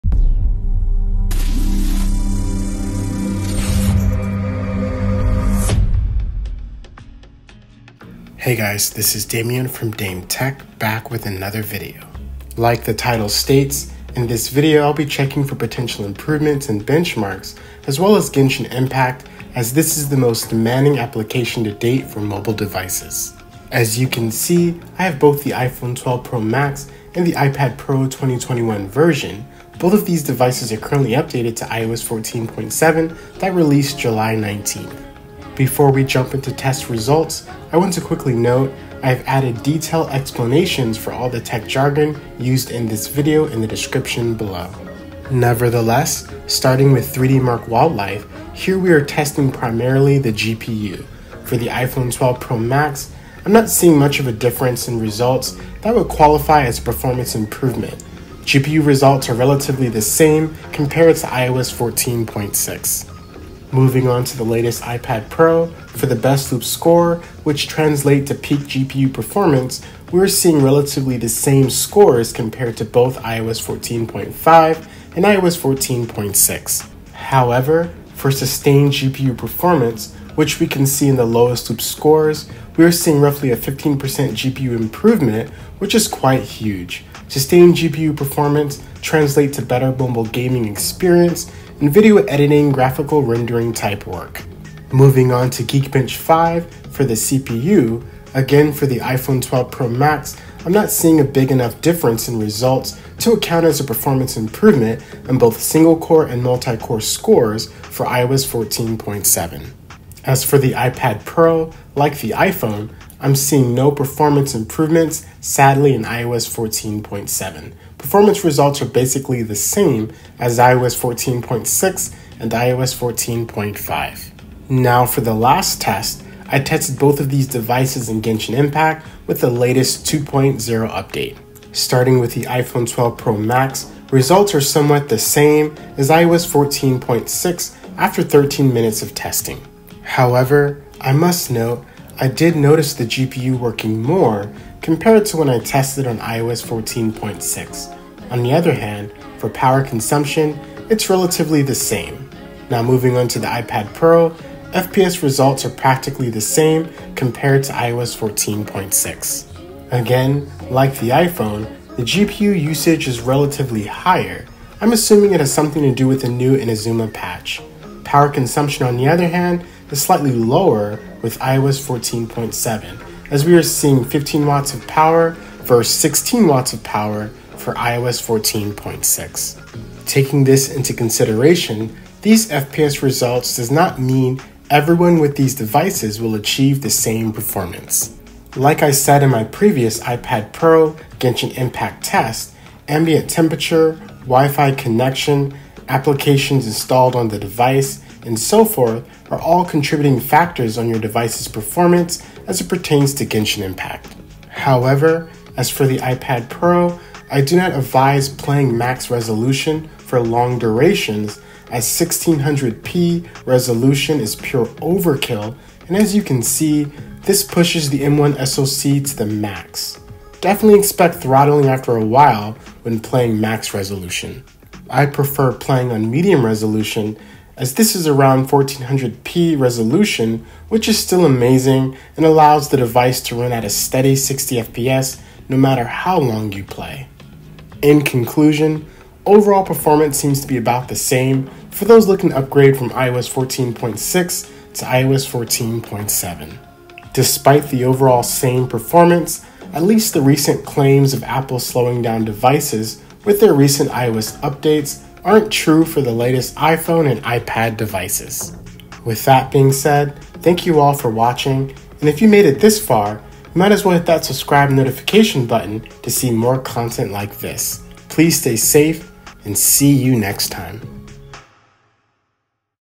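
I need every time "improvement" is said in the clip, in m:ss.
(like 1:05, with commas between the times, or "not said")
0:16, 0:57, 1:24, 1:44, 1:54.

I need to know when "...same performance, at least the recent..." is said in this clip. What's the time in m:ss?
4:08.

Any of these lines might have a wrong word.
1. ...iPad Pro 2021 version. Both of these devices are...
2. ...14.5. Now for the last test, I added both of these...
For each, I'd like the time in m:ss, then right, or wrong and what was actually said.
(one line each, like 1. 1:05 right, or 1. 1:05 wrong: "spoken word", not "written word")
1. 0:27 right
2. 2:03 wrong: "tested", not "added".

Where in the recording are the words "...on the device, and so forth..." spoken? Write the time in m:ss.
3:17.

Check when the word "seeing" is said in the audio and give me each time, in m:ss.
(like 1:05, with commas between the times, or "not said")
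0:53, 1:10, 1:22, 1:40, 1:53, 2:53.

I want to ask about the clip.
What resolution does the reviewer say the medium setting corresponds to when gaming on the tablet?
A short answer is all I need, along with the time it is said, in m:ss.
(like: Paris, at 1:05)
1400p, at 3:48.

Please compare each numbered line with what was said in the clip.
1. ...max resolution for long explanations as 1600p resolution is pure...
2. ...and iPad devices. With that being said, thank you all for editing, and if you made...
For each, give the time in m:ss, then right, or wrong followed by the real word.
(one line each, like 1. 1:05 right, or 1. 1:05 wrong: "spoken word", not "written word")
1. 3:28 wrong: "durations", not "explanations"
2. 4:17 wrong: "watching", not "editing".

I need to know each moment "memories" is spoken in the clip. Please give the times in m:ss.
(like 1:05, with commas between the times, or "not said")
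not said.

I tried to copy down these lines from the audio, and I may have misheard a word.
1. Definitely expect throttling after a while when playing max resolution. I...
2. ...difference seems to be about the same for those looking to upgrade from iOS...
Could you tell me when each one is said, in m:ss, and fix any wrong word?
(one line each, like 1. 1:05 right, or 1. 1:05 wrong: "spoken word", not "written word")
1. 3:40 right
2. 3:59 wrong: "performance", not "difference".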